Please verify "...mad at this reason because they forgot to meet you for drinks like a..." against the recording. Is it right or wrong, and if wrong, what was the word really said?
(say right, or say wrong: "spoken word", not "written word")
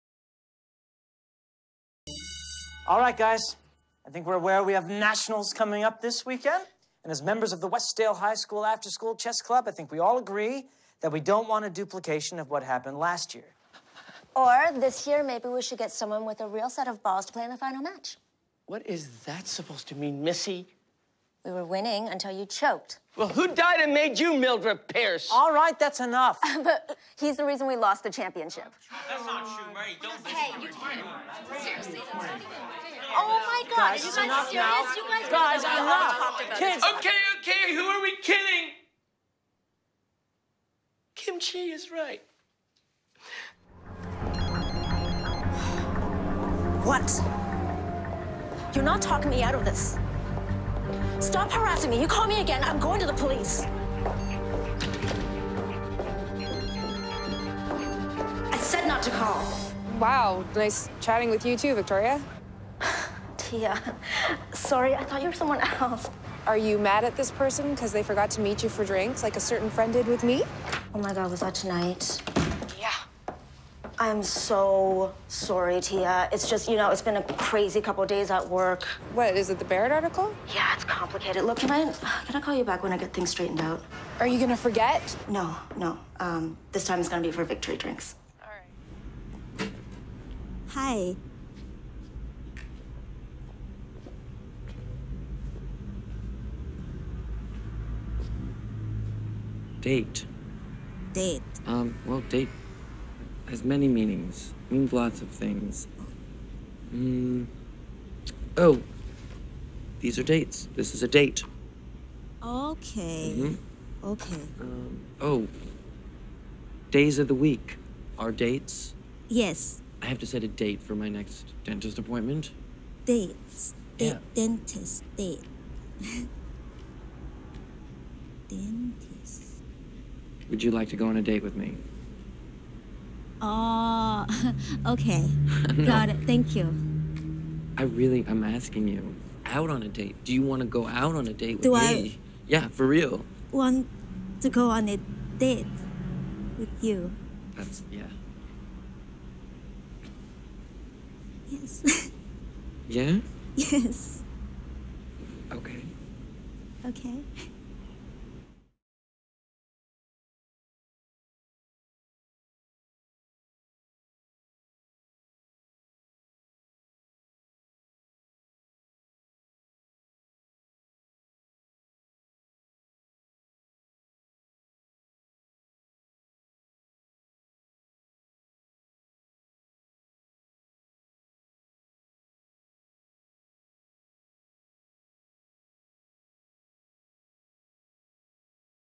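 wrong: "person", not "reason".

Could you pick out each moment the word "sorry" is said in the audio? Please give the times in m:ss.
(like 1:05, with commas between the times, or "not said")
1:04, 1:15.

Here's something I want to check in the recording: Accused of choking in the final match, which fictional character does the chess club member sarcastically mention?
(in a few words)
Mildred Pierce.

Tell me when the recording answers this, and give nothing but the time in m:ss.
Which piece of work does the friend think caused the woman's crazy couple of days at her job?
1:19.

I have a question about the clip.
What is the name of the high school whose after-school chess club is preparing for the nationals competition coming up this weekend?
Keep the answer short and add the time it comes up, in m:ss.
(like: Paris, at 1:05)
Westdale High School, at 0:07.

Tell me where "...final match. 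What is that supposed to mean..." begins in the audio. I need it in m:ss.
0:17.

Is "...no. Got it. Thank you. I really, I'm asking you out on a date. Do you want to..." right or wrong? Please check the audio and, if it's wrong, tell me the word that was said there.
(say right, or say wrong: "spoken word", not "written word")
right.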